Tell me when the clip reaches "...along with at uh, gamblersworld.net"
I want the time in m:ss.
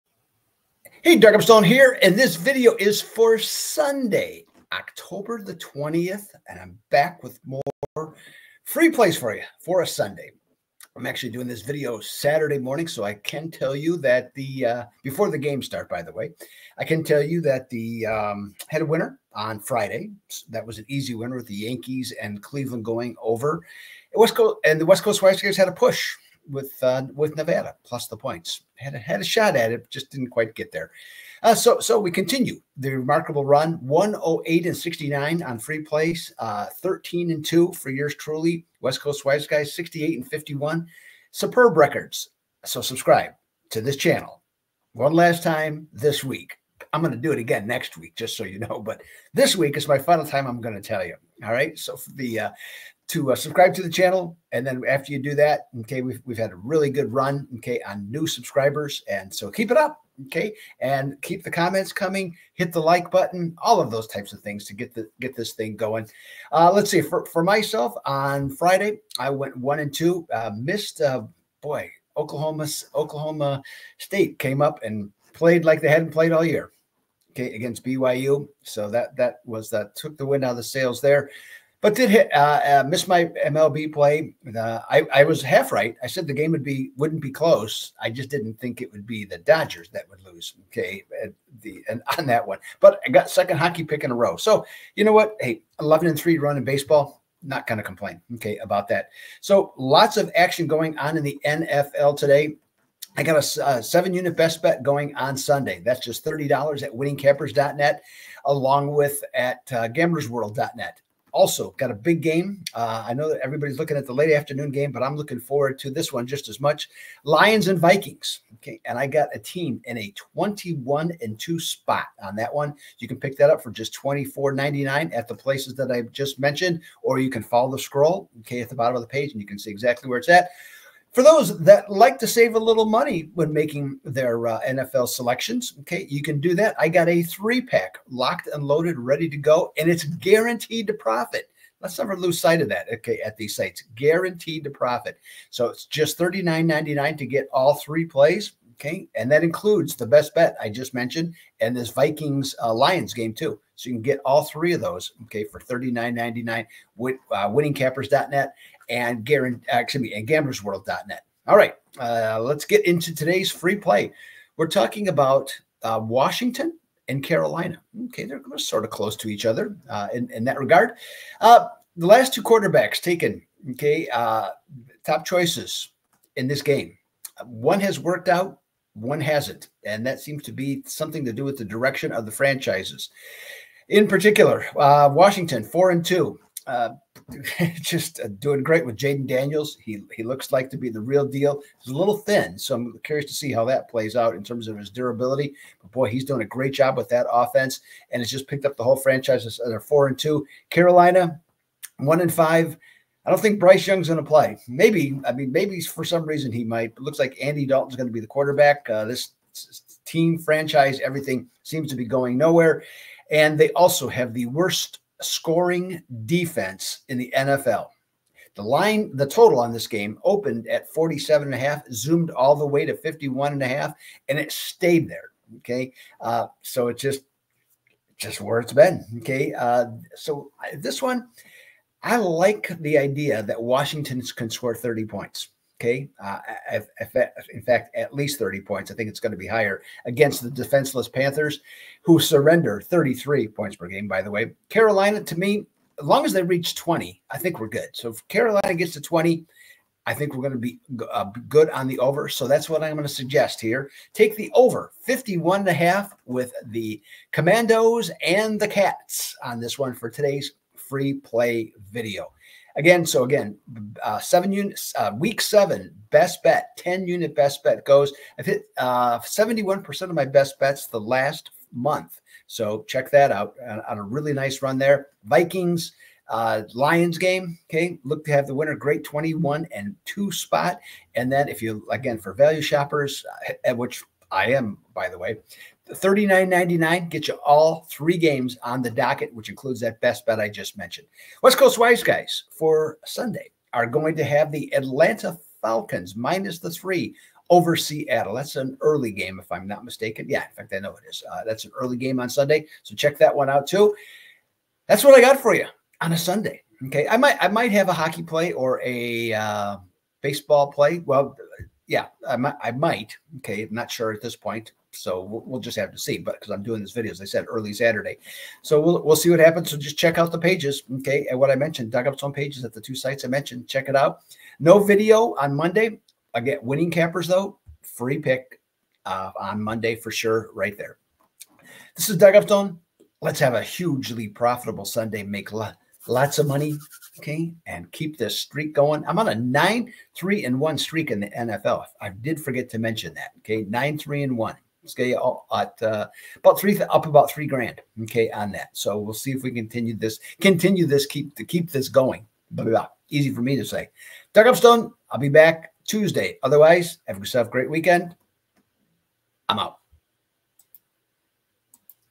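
1:48.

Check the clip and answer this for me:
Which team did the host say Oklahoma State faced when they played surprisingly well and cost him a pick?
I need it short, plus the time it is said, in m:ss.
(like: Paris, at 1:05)
BYU, at 1:17.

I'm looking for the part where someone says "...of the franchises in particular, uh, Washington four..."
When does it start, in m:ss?
3:02.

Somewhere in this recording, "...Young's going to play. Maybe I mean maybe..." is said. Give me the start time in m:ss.
3:23.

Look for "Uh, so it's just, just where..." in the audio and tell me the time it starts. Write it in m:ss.
3:46.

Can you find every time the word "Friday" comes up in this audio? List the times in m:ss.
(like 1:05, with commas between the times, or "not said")
0:19, 1:08.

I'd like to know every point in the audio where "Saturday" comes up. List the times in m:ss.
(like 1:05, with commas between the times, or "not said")
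0:12, 5:17.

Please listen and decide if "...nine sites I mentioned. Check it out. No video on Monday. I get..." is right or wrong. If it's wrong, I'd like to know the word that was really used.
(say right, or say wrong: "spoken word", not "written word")
wrong: "two", not "nine".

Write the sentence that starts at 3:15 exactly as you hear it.
But boy, he's doing a great job with that offense, and it's just picked up the whole franchise.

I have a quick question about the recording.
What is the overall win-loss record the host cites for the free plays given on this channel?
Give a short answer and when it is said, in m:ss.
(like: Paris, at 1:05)
108 and 69, at 0:33.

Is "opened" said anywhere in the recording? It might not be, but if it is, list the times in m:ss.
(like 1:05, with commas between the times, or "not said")
3:40.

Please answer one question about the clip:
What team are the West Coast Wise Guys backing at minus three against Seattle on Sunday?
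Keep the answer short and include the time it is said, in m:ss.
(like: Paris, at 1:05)
Atlanta Falcons, at 4:54.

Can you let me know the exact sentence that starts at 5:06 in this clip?
Okay, I might I might have a hockey play or a uh, baseball play.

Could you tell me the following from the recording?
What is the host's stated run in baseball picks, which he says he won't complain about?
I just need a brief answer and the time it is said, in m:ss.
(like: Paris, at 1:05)
11 and 3, at 1:35.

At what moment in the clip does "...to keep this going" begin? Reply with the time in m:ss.
5:51.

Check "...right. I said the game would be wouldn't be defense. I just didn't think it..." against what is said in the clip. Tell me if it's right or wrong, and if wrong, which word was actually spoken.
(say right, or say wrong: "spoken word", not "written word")
wrong: "close", not "defense".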